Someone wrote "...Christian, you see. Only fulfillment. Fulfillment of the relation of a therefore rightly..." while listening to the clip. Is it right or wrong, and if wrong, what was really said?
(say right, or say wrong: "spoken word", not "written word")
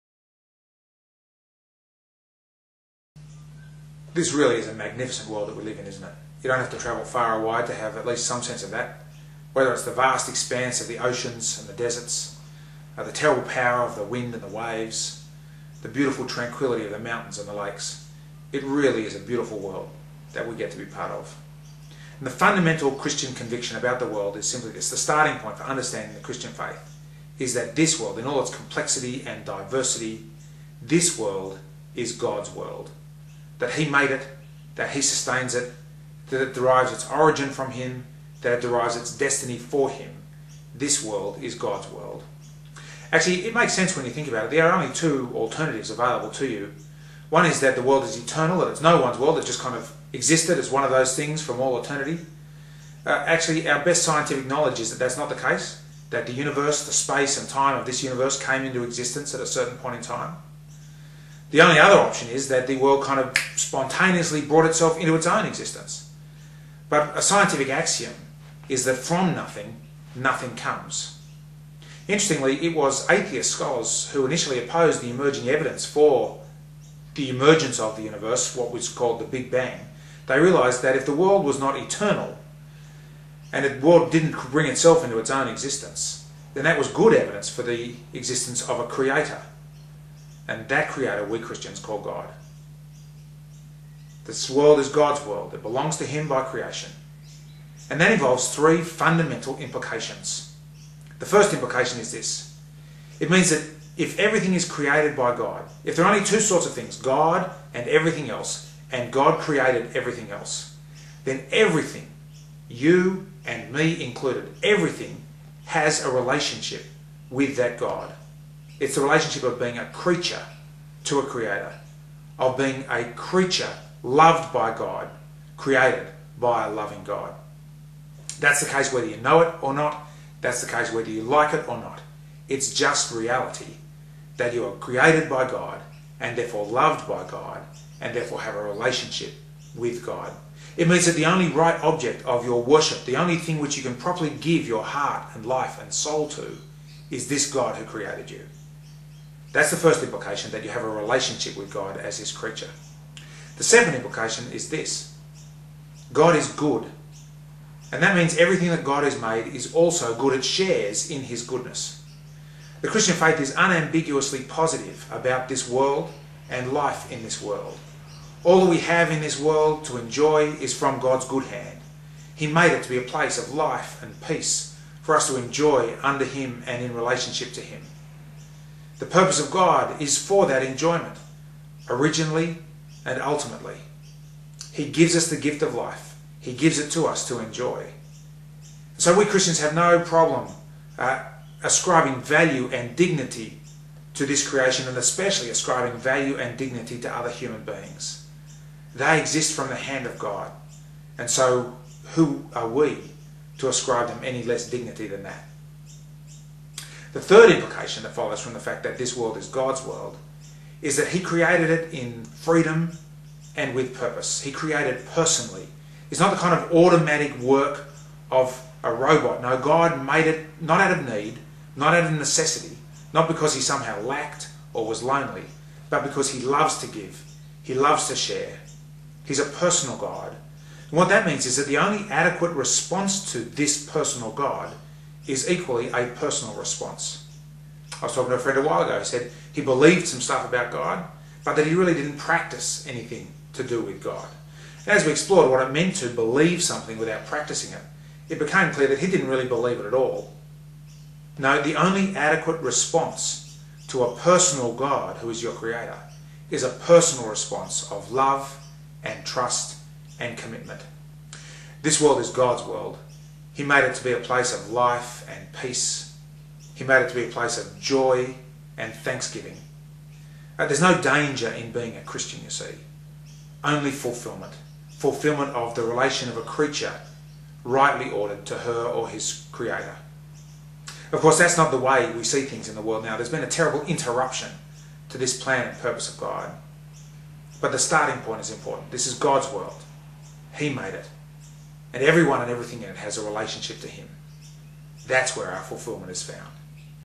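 wrong: "creature", not "therefore".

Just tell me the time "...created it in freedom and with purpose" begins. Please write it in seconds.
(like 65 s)
211 s.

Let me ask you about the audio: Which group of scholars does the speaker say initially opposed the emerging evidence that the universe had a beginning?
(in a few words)
atheist scholars.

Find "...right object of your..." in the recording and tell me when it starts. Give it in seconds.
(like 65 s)
141 s.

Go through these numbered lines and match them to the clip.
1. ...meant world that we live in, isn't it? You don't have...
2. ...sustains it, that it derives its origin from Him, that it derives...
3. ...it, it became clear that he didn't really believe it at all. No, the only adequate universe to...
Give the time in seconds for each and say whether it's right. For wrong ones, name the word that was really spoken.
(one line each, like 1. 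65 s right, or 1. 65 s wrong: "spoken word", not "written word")
1. 4 s wrong: "magnificent", not "meant"
2. 35 s right
3. 247 s wrong: "response", not "universe".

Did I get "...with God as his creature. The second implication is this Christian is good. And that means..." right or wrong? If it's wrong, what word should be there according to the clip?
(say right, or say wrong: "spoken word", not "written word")
wrong: "God", not "Christian".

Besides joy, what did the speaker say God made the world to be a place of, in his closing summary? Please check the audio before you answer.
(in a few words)
thanksgiving.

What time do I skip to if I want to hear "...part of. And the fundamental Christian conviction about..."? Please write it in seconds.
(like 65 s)
20 s.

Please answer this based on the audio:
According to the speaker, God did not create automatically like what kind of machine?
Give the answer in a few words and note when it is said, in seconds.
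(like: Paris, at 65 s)
a robot, at 218 s.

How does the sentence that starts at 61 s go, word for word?
The only other option is that the world kind of spontaneously brought itself into its own existence.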